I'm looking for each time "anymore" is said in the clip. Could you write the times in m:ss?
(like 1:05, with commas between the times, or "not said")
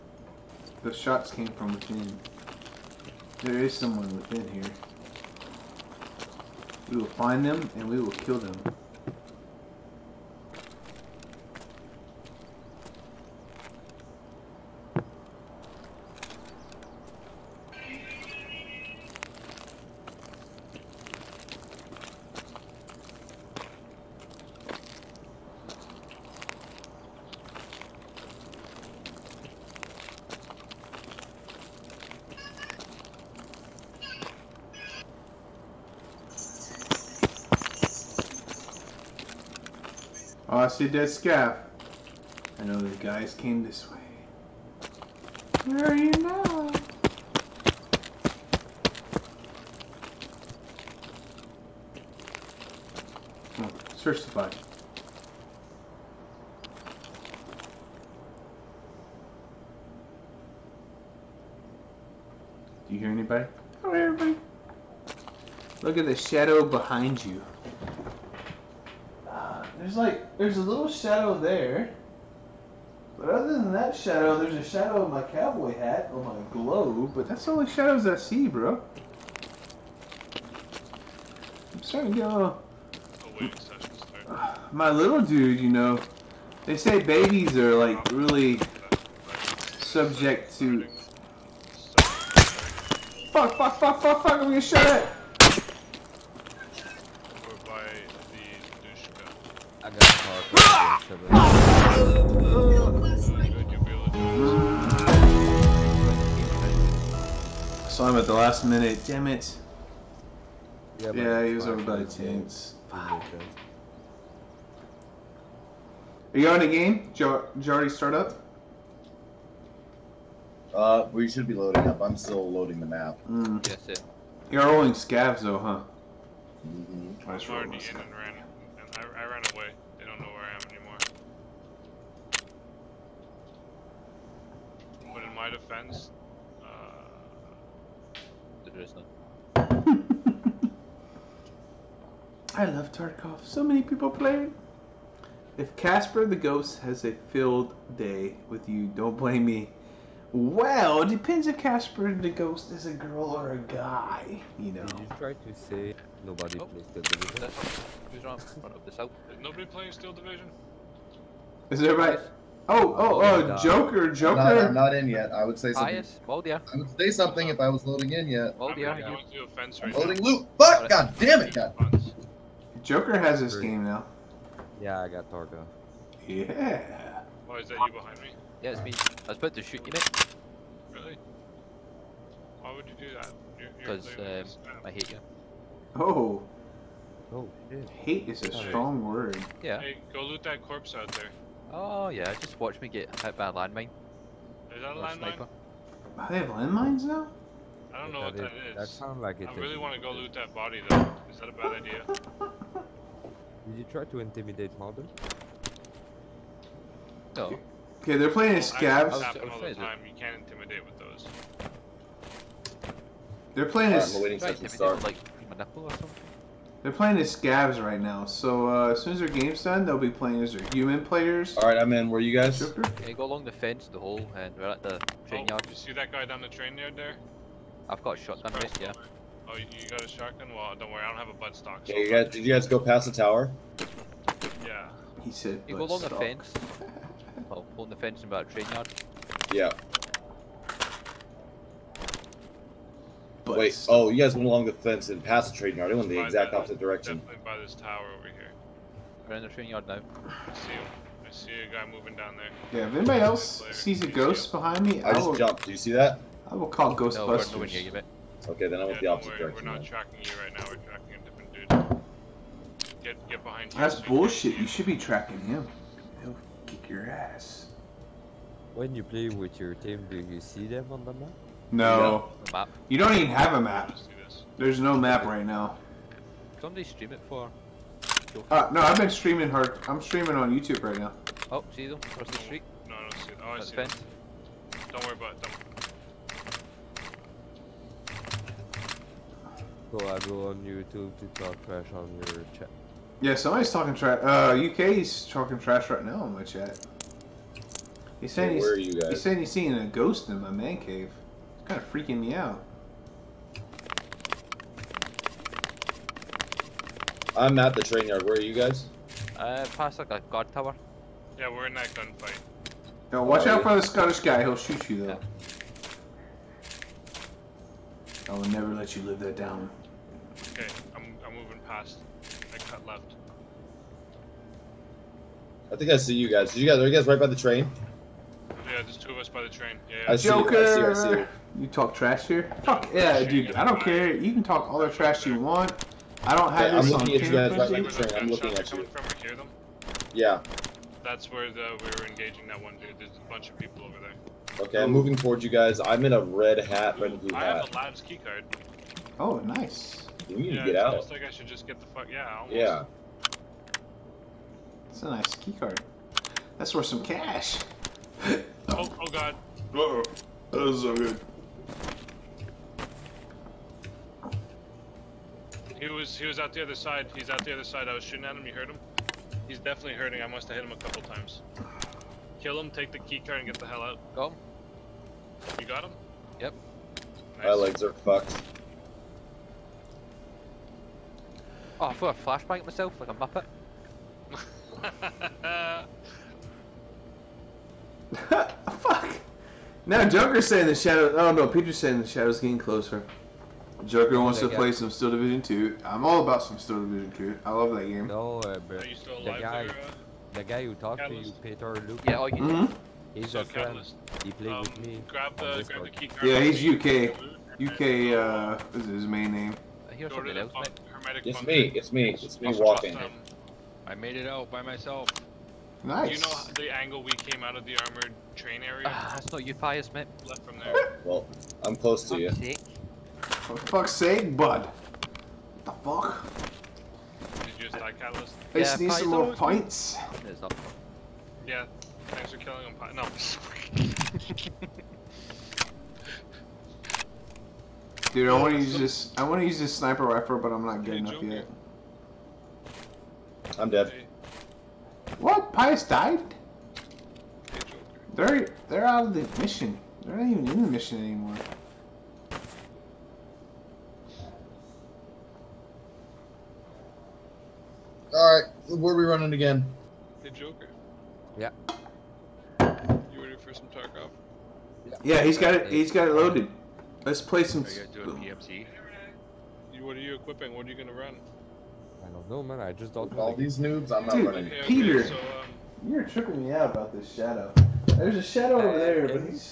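2:10, 7:30.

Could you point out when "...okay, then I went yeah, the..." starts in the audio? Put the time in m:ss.
4:18.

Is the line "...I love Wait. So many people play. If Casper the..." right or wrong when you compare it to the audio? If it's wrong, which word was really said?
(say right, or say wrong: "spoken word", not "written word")
wrong: "Tarkov", not "Wait".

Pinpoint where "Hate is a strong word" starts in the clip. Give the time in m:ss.
3:07.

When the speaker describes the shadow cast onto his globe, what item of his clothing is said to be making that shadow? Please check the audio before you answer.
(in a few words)
cowboy hat.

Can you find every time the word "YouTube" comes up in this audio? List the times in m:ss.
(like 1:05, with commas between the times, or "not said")
4:40, 4:50.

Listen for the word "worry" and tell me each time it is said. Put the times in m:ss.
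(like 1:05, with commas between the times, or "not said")
3:50, 4:19, 4:45.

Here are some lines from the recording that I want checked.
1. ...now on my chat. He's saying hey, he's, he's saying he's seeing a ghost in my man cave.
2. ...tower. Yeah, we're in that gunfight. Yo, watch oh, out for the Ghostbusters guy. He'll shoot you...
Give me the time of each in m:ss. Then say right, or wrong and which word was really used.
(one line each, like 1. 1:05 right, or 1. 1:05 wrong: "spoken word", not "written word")
1. 4:56 right
2. 5:10 wrong: "Scottish", not "Ghostbusters".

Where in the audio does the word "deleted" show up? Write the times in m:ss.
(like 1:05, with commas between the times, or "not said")
not said.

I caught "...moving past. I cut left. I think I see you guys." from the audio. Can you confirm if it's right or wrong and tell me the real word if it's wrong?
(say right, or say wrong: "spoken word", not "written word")
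right.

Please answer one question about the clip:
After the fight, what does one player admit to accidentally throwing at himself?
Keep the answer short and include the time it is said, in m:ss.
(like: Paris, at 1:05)
flashbang, at 6:22.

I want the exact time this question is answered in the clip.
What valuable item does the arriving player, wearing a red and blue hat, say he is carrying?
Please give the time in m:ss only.
5:47.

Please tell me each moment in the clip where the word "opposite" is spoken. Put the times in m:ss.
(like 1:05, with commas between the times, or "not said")
4:06, 4:19.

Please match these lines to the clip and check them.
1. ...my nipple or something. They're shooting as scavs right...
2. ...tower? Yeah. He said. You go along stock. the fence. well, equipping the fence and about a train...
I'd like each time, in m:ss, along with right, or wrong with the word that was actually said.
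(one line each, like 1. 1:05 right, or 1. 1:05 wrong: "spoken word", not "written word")
1. 3:35 wrong: "playing", not "shooting"
2. 3:53 wrong: "along", not "equipping".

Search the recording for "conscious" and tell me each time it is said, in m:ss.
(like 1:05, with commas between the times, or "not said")
not said.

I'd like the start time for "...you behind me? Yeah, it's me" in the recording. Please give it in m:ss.
2:57.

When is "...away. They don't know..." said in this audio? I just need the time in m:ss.
2:09.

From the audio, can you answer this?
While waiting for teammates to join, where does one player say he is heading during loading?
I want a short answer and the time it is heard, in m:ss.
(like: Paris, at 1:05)
a fence, at 2:49.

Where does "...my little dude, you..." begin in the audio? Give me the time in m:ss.
1:24.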